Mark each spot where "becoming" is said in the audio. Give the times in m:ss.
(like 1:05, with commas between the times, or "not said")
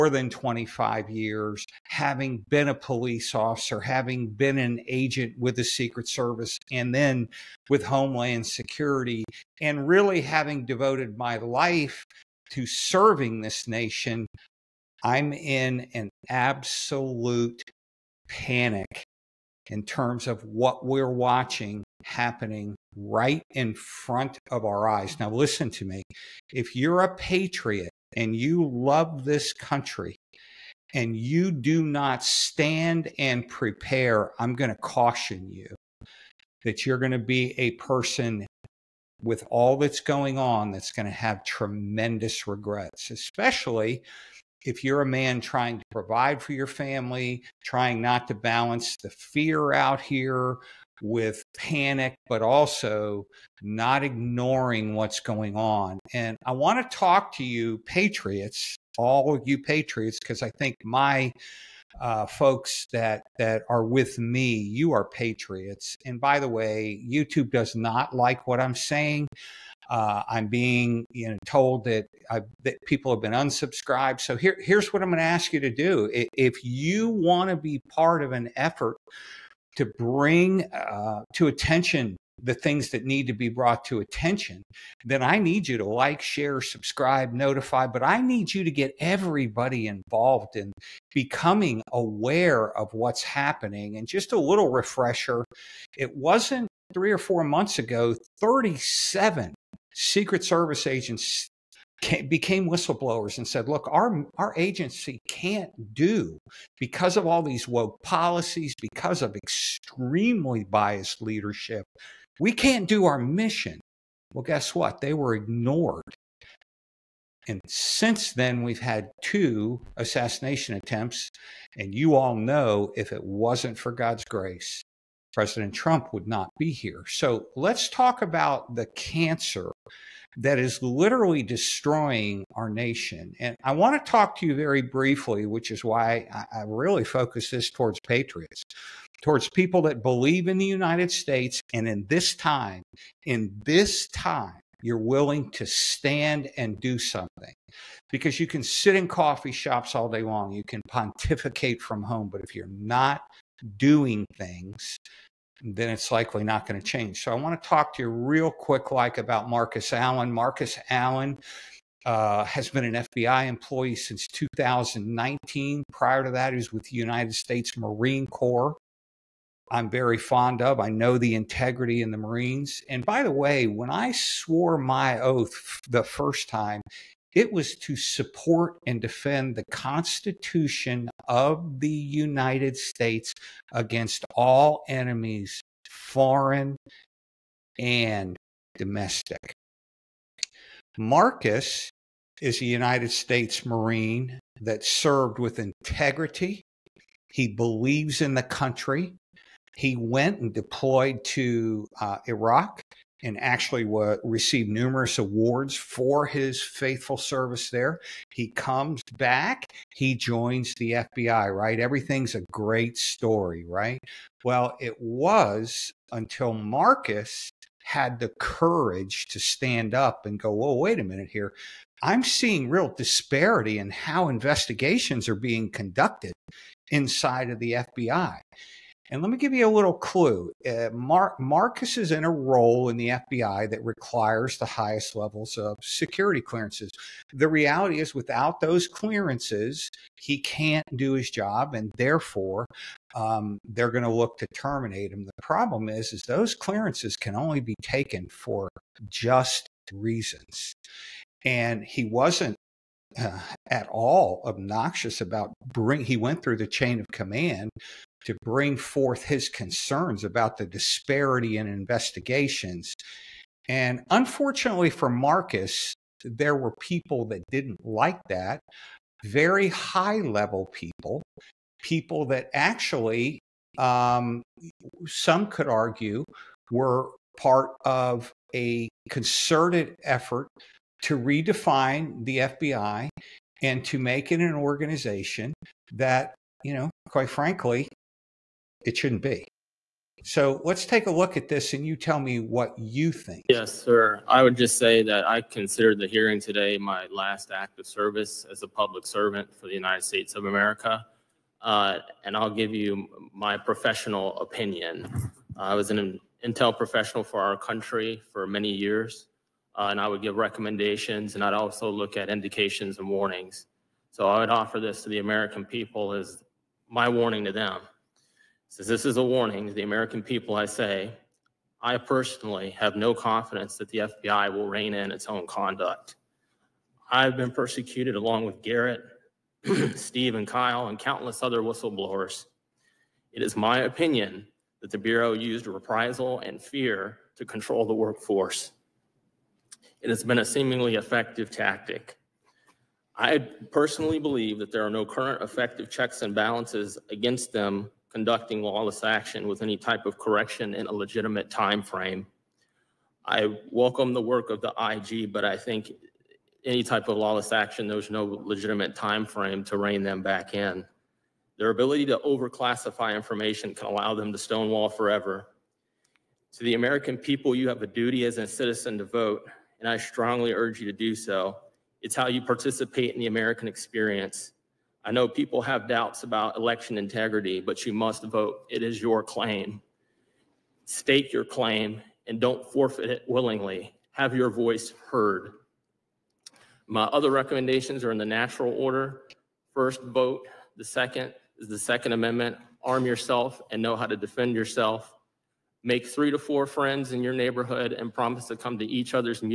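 1:31.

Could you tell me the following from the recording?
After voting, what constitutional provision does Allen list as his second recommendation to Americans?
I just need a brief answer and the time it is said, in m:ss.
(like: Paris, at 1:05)
Second Amendment, at 6:31.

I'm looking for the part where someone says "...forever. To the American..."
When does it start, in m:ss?
6:04.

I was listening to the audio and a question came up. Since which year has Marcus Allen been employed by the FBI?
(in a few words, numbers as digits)
2019.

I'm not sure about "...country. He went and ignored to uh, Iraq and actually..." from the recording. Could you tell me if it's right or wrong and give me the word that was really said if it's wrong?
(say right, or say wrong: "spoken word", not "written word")
wrong: "deployed", not "ignored".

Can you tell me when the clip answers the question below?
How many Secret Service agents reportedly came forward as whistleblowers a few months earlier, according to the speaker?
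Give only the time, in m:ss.
1:38.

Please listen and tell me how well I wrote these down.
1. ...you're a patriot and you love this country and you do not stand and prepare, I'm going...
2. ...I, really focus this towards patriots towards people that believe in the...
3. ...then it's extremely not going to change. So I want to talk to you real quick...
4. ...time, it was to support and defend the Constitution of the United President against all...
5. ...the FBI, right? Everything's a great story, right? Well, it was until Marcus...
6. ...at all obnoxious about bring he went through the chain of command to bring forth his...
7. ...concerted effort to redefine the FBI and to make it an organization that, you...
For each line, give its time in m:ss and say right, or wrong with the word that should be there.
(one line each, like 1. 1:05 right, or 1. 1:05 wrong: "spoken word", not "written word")
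1. 0:26 right
2. 2:16 right
3. 2:35 wrong: "likely", not "extremely"
4. 2:56 wrong: "States", not "President"
5. 3:30 right
6. 4:13 right
7. 4:39 right.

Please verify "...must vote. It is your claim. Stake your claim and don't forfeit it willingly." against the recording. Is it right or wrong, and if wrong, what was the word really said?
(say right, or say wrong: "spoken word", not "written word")
right.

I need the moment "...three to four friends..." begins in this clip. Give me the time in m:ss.
6:36.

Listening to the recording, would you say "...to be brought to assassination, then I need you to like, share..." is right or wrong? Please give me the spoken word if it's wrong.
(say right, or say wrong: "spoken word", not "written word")
wrong: "attention", not "assassination".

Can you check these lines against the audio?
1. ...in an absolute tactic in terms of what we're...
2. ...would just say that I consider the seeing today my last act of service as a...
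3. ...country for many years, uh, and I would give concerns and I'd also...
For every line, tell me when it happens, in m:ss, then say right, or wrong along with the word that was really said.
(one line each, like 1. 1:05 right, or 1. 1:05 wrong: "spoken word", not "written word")
1. 0:15 wrong: "panic", not "tactic"
2. 4:54 wrong: "hearing", not "seeing"
3. 5:07 wrong: "recommendations", not "concerns".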